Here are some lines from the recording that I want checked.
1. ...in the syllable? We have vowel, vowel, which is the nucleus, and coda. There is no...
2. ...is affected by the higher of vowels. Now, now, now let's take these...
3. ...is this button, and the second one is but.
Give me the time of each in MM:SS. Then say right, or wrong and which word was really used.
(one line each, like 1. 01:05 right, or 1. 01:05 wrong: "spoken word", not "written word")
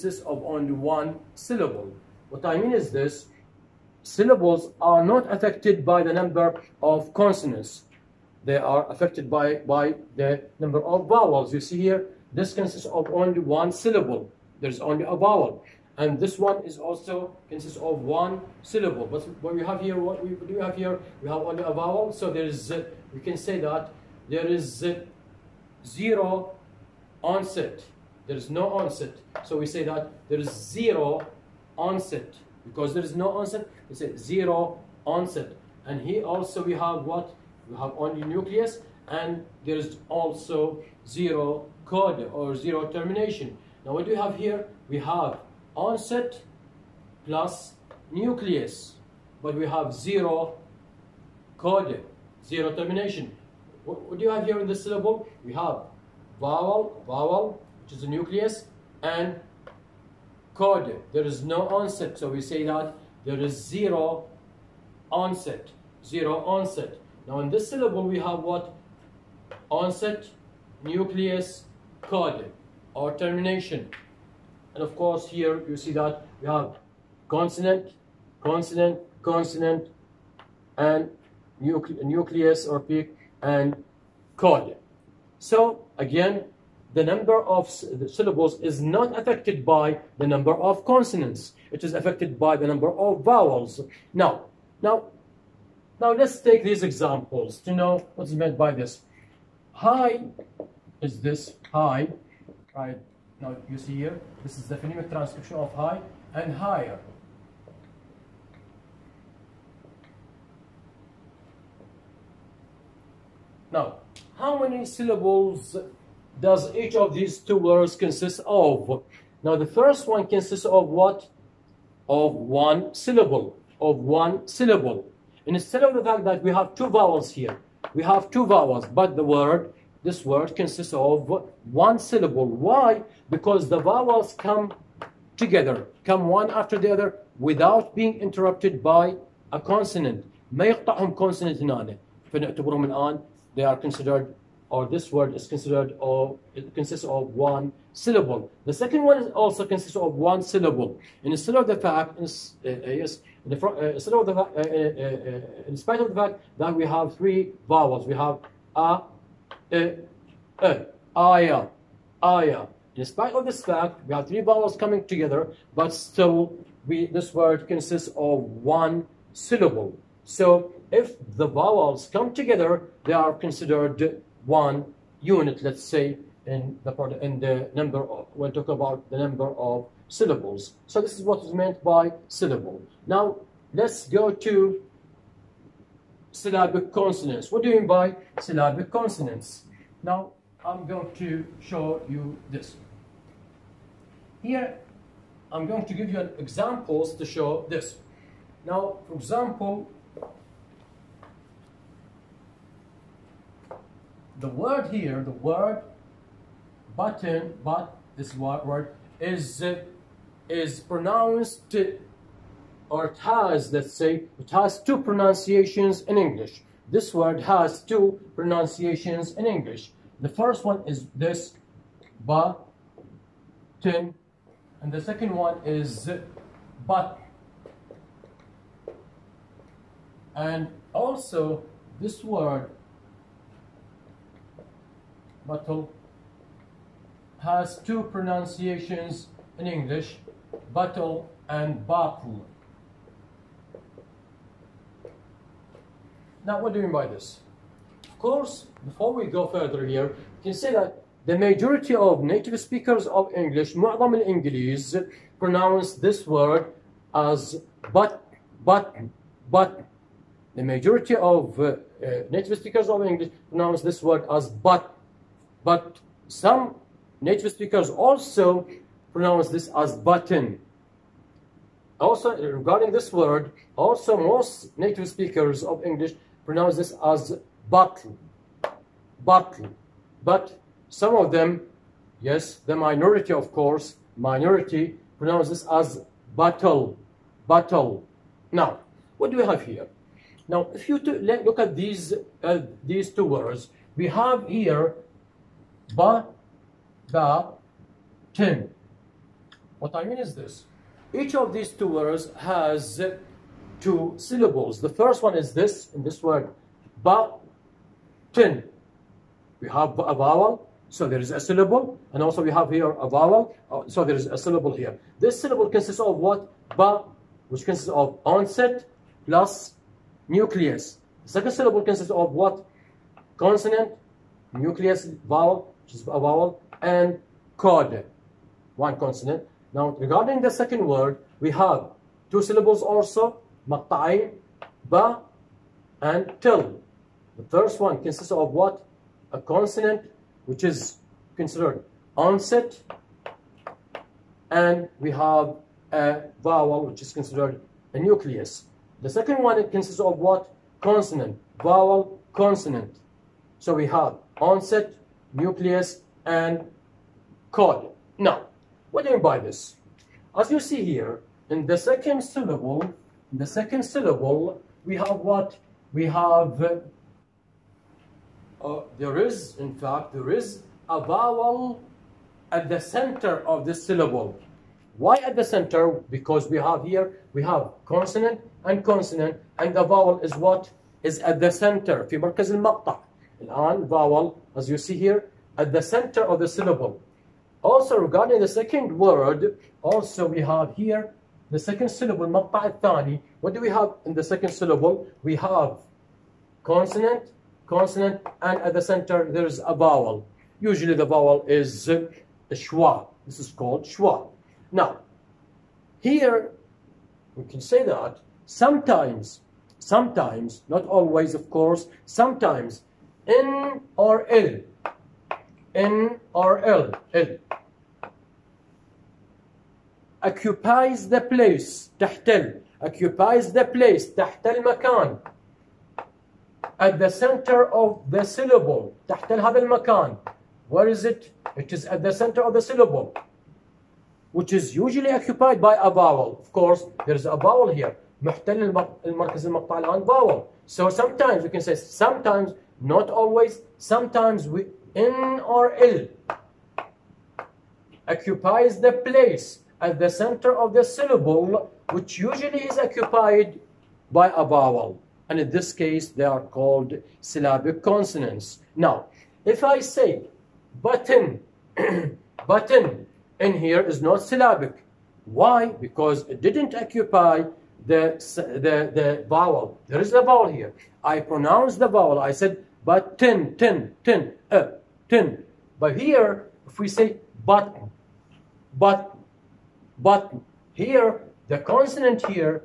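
1. 00:54 right
2. 01:31 wrong: "number", not "higher"
3. 03:40 right.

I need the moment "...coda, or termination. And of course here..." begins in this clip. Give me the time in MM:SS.
01:12.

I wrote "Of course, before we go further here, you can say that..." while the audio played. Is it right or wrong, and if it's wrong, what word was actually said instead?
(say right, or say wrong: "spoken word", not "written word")
right.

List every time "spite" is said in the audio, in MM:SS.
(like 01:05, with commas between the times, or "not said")
02:35, 02:43.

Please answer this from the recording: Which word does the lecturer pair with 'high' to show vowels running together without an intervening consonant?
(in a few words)
Higher.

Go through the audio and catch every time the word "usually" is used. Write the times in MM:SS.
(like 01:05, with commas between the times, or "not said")
06:40, 07:14, 07:32.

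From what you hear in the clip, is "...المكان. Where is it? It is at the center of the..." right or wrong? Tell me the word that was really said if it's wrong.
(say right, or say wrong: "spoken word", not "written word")
right.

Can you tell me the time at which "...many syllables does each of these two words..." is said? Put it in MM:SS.
01:54.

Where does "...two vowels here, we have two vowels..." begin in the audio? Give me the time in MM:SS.
02:06.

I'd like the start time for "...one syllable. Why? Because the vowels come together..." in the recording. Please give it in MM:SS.
02:11.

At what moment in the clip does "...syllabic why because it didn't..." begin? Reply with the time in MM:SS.
07:44.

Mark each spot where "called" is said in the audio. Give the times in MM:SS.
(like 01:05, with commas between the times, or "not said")
06:43, 07:36.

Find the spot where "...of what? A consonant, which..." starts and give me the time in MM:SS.
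05:38.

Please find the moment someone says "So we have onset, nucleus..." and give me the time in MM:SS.
05:53.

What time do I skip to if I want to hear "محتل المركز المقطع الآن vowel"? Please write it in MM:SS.
07:18.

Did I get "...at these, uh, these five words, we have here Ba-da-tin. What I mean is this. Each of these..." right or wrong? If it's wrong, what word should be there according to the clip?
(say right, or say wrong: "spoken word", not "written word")
wrong: "two", not "five".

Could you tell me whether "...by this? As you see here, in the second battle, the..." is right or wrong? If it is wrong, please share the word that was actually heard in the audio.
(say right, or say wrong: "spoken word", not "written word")
wrong: "syllable", not "battle".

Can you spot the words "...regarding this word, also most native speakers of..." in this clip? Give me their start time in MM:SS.
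04:32.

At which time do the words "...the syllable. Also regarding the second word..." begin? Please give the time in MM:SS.
06:26.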